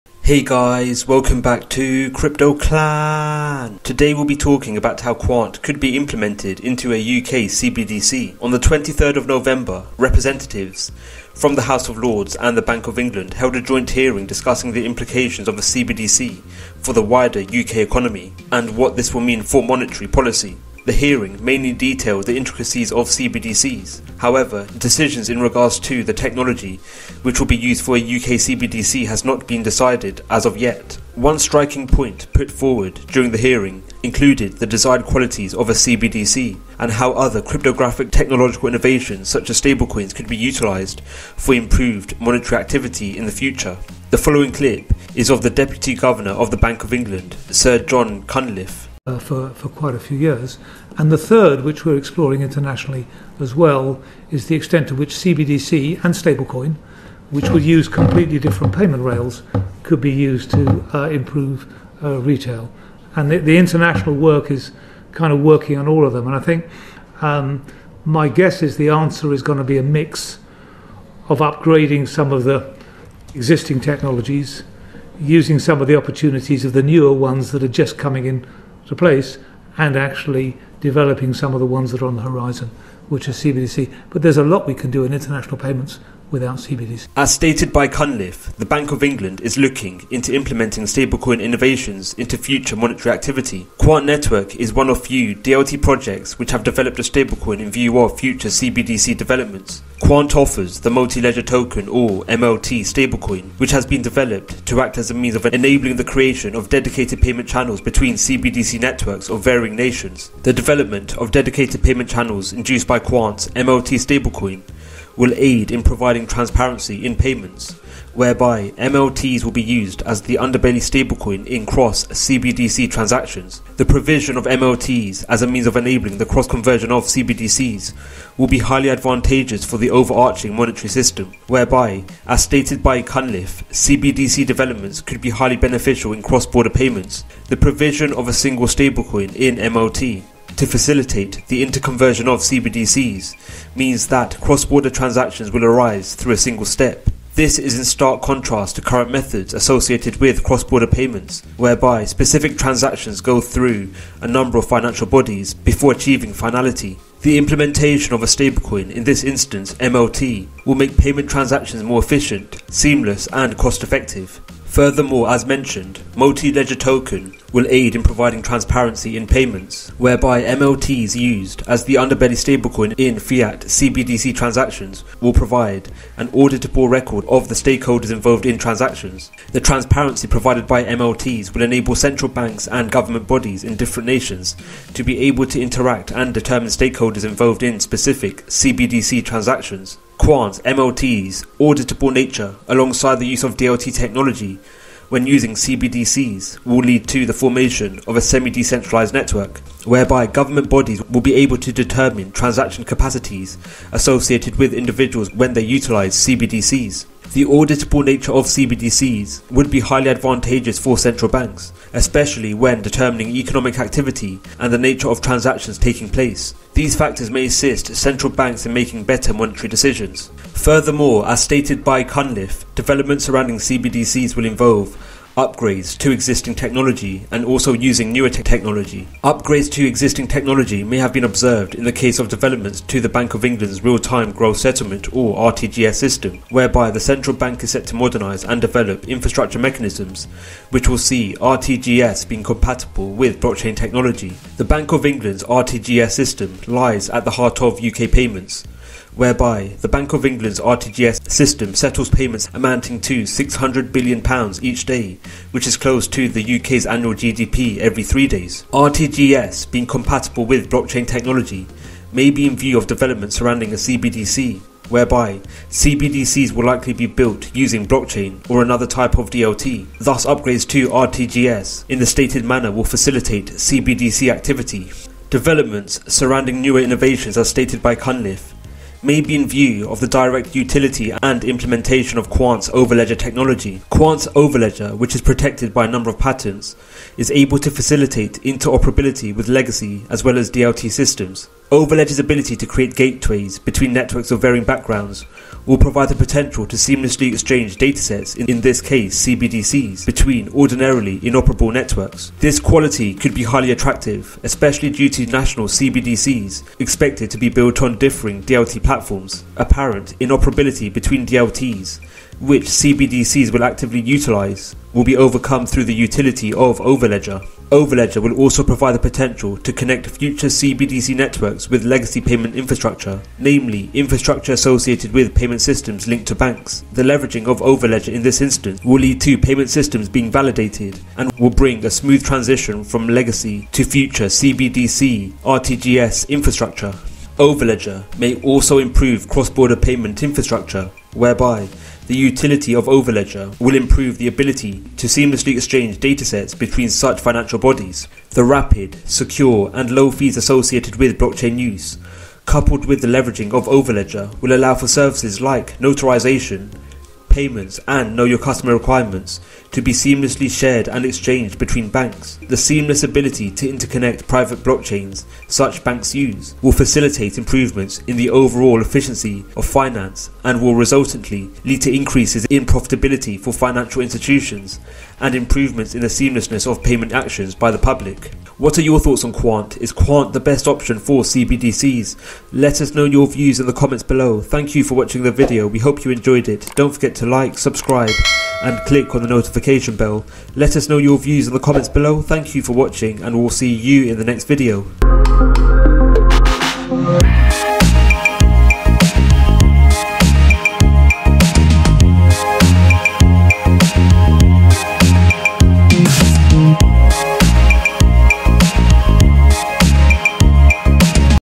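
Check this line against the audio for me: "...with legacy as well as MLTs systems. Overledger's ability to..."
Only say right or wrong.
wrong.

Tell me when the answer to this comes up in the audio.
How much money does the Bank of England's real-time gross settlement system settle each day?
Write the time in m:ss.
4:13.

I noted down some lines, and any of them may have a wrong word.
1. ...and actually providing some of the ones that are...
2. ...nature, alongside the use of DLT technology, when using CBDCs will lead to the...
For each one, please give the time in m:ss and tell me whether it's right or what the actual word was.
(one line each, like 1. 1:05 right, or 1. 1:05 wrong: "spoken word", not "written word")
1. 1:19 wrong: "developing", not "providing"
2. 3:12 right.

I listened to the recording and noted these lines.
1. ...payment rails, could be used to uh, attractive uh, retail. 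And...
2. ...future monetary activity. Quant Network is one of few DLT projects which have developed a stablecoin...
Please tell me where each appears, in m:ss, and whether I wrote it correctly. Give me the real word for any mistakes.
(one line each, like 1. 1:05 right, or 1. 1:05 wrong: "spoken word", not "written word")
1. 0:58 wrong: "improve", not "attractive"
2. 1:32 right.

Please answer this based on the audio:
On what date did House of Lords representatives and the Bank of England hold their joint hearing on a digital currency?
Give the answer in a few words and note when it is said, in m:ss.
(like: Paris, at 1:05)
23 November, at 0:08.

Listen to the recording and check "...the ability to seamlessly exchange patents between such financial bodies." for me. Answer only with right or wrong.
wrong.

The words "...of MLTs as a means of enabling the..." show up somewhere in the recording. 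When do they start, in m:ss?
2:04.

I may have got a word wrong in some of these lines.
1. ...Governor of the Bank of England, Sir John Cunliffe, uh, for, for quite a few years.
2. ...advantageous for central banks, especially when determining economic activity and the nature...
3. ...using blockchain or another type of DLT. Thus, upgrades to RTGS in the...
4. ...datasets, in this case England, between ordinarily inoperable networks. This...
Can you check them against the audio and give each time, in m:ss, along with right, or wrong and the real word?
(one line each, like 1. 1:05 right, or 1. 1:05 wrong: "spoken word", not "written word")
1. 0:45 right
2. 3:30 right
3. 4:27 right
4. 4:57 wrong: "CBDCs", not "England".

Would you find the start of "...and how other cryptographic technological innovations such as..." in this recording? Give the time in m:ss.
0:36.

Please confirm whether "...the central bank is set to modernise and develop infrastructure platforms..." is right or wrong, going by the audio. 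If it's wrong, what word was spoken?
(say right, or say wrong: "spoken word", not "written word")
wrong: "mechanisms", not "platforms".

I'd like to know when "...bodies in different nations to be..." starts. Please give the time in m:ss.
3:03.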